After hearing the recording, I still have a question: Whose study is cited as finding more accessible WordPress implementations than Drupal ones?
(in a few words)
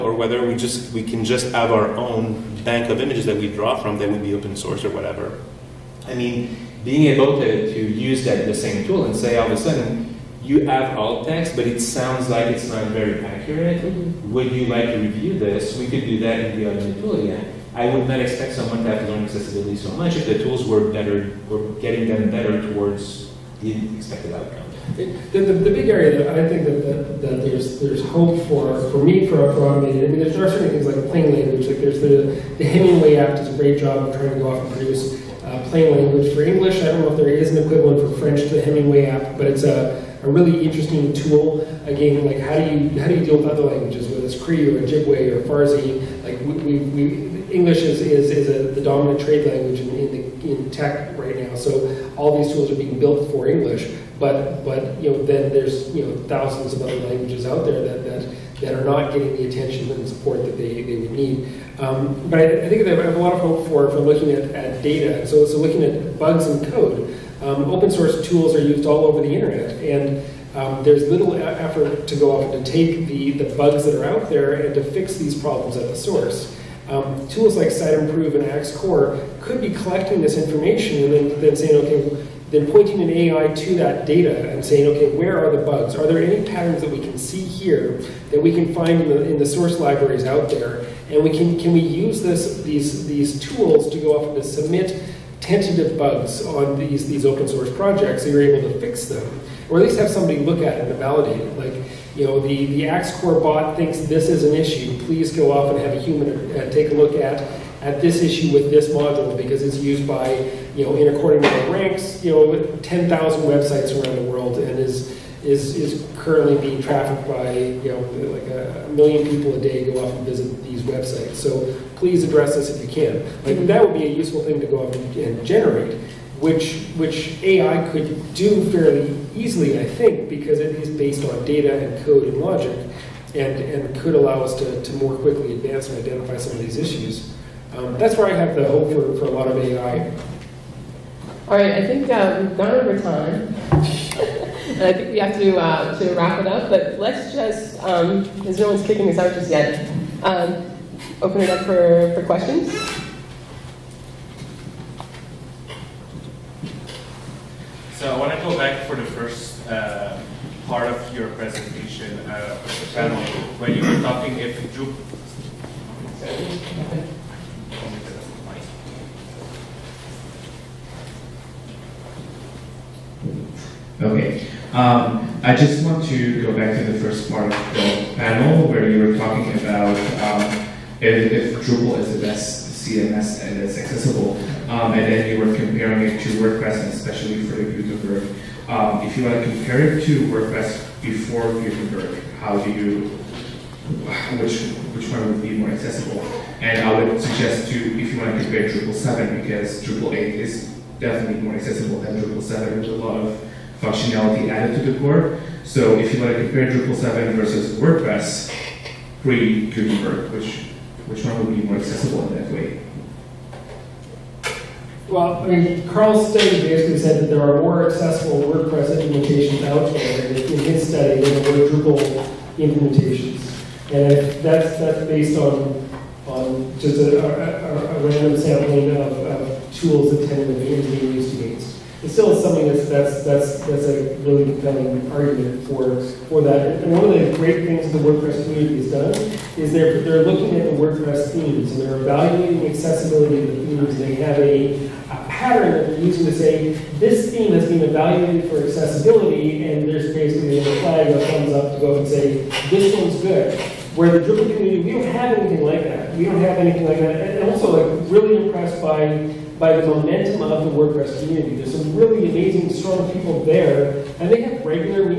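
Karl.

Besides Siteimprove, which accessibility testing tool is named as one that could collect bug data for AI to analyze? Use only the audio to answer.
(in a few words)
Axe Core.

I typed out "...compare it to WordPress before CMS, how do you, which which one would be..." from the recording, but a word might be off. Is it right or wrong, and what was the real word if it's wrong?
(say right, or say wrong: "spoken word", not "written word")
wrong: "Gutenberg", not "CMS".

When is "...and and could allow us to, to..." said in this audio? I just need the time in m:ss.
2:13.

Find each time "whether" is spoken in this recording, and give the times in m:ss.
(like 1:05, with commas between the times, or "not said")
0:00, 0:44.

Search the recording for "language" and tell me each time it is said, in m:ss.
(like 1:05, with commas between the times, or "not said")
0:31, 0:35, 0:43, 0:49, 0:57.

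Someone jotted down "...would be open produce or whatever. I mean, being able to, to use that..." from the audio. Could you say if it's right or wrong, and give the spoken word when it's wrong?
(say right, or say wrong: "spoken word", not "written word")
wrong: "source", not "produce".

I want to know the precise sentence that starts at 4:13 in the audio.
Where the Drupal community, we don't have anything like that.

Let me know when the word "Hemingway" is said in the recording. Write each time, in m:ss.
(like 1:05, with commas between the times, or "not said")
0:32, 0:38.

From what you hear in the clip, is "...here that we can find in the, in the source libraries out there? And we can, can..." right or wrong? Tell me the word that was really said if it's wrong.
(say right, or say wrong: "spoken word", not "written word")
right.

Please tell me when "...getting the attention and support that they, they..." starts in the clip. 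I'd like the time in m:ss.
0:59.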